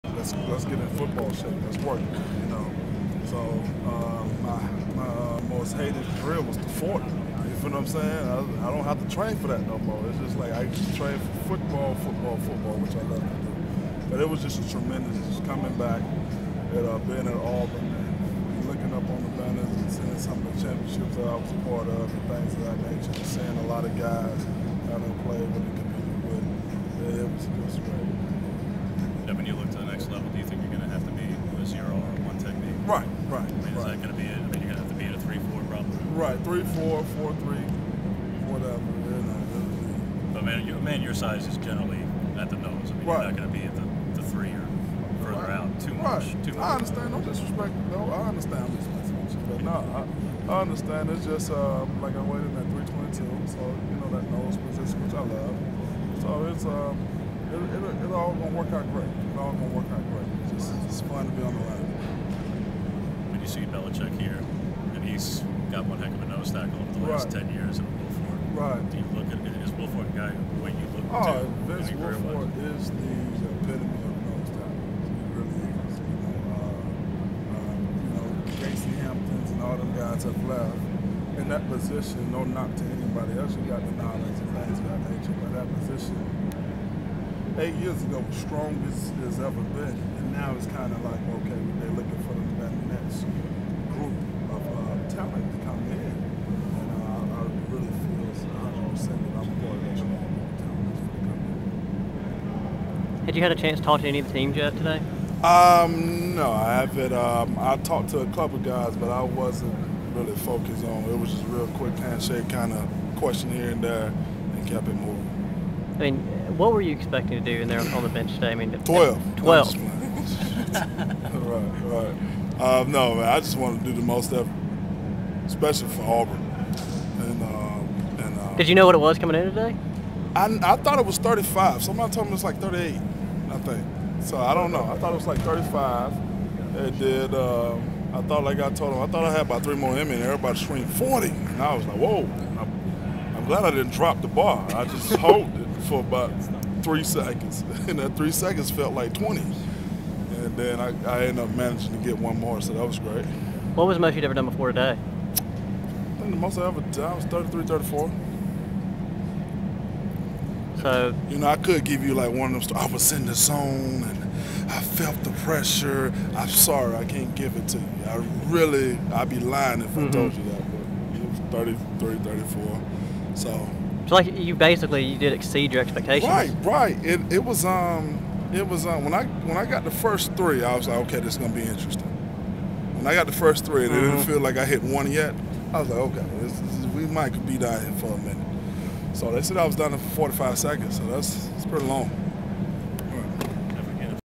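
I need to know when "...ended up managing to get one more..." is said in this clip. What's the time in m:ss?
2:31.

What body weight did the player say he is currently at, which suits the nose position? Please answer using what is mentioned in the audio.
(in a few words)
322.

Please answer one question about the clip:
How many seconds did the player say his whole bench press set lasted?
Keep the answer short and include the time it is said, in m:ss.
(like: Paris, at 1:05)
45, at 3:09.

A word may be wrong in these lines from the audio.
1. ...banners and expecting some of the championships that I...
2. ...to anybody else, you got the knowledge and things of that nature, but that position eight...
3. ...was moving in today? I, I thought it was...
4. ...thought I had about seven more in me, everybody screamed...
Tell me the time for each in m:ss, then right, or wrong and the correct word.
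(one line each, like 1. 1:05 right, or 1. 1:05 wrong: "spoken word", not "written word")
1. 0:19 wrong: "seeing", not "expecting"
2. 1:22 right
3. 2:08 wrong: "coming", not "moving"
4. 2:19 wrong: "three", not "seven".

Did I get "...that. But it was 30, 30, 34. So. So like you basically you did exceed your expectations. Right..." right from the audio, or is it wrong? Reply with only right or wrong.
right.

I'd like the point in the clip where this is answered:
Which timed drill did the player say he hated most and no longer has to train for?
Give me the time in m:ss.
0:06.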